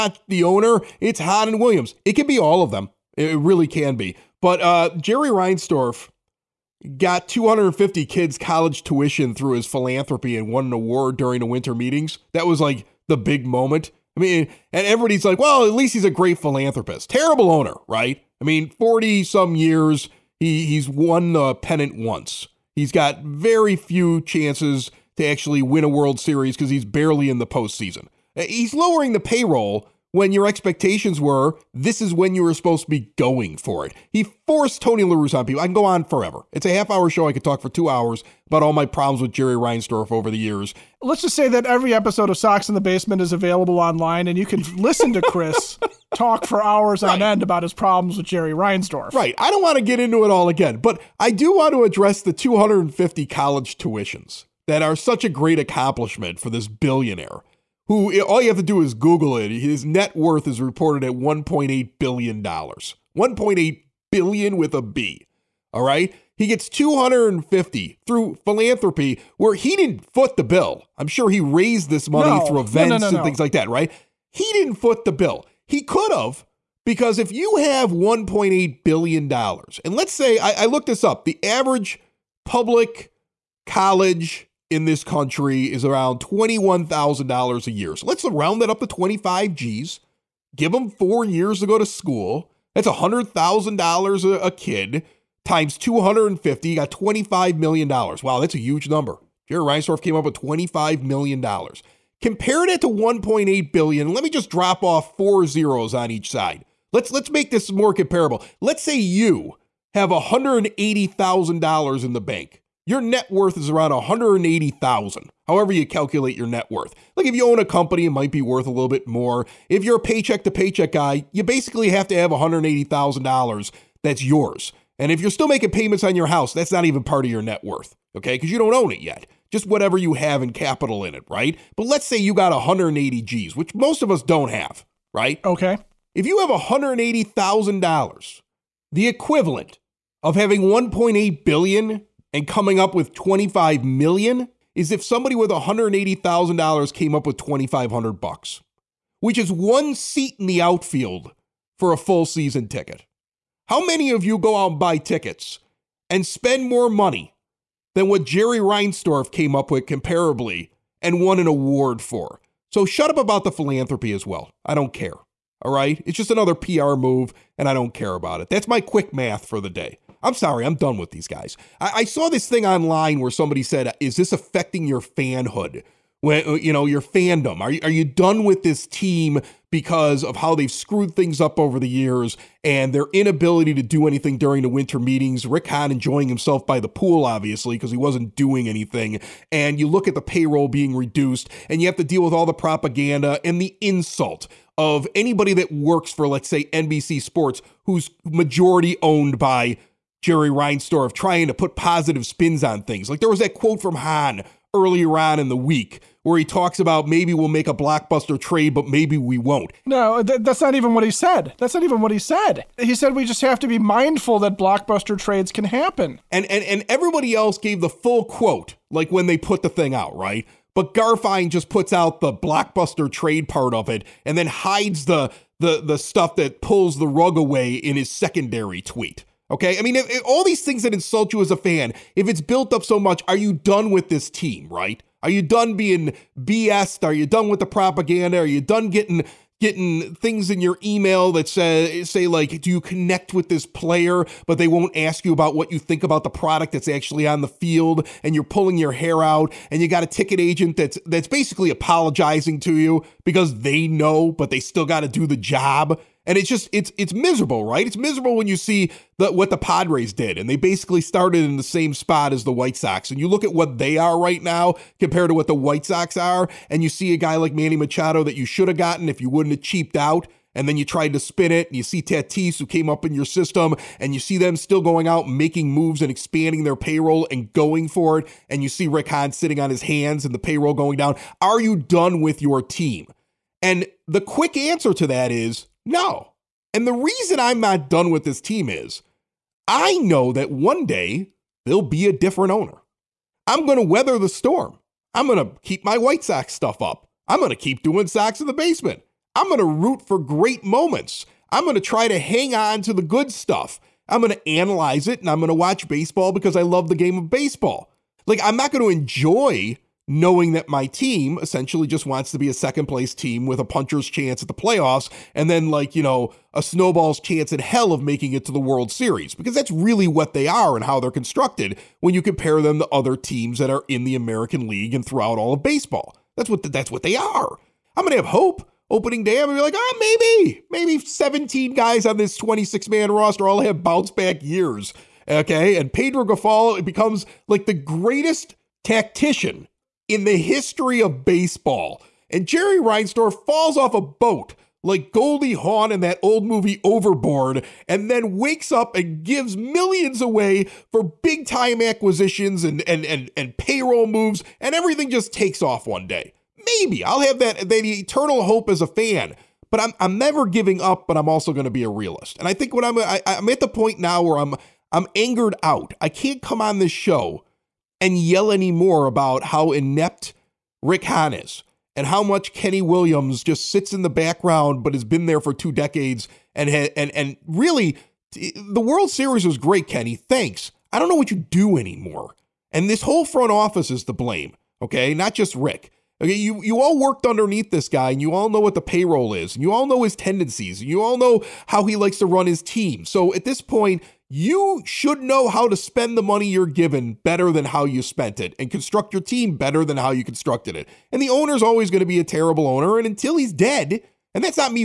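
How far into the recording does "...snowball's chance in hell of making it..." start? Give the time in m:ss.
5:16.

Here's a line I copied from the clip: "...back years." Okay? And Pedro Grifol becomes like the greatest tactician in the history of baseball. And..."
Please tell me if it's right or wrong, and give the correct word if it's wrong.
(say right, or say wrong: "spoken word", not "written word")
right.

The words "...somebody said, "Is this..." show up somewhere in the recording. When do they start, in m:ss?
2:53.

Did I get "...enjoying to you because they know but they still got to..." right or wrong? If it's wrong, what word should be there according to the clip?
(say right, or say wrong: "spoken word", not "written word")
wrong: "apologizing", not "enjoying".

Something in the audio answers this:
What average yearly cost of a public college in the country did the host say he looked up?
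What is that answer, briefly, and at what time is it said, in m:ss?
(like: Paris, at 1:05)
$21,000, at 1:26.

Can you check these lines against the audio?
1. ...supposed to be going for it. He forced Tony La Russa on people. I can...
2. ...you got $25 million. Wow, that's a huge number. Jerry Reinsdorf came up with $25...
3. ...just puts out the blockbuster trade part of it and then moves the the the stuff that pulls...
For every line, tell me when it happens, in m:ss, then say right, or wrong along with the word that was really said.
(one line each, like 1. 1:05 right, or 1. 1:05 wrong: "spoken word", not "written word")
1. 0:32 right
2. 1:36 right
3. 3:41 wrong: "hides", not "moves".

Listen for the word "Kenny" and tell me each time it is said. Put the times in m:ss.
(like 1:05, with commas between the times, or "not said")
6:12, 6:19.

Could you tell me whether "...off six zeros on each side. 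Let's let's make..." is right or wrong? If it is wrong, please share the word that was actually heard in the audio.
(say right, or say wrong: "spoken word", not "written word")
wrong: "four", not "six".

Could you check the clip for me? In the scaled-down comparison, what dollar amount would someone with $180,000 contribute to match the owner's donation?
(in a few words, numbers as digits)
2500.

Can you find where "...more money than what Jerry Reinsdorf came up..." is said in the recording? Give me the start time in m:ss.
2:36.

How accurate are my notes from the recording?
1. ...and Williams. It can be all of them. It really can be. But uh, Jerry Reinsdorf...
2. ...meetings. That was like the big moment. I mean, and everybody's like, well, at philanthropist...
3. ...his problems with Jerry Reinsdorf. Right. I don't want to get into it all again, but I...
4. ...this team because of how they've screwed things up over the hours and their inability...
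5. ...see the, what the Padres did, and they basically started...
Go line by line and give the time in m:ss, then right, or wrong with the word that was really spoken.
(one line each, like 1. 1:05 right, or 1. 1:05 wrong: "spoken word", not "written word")
1. 0:01 right
2. 0:11 wrong: "least", not "philanthropist"
3. 0:47 right
4. 2:58 wrong: "years", not "hours"
5. 4:18 right.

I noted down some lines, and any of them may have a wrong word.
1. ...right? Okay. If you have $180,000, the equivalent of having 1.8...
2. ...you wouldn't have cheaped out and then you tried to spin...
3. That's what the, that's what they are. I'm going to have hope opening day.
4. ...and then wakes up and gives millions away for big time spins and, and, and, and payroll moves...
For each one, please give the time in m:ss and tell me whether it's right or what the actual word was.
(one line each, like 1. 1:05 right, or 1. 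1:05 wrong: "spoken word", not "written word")
1. 2:15 right
2. 4:29 right
3. 5:26 right
4. 5:47 wrong: "acquisitions", not "spins".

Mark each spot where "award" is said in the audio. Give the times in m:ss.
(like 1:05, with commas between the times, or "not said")
0:10, 2:41.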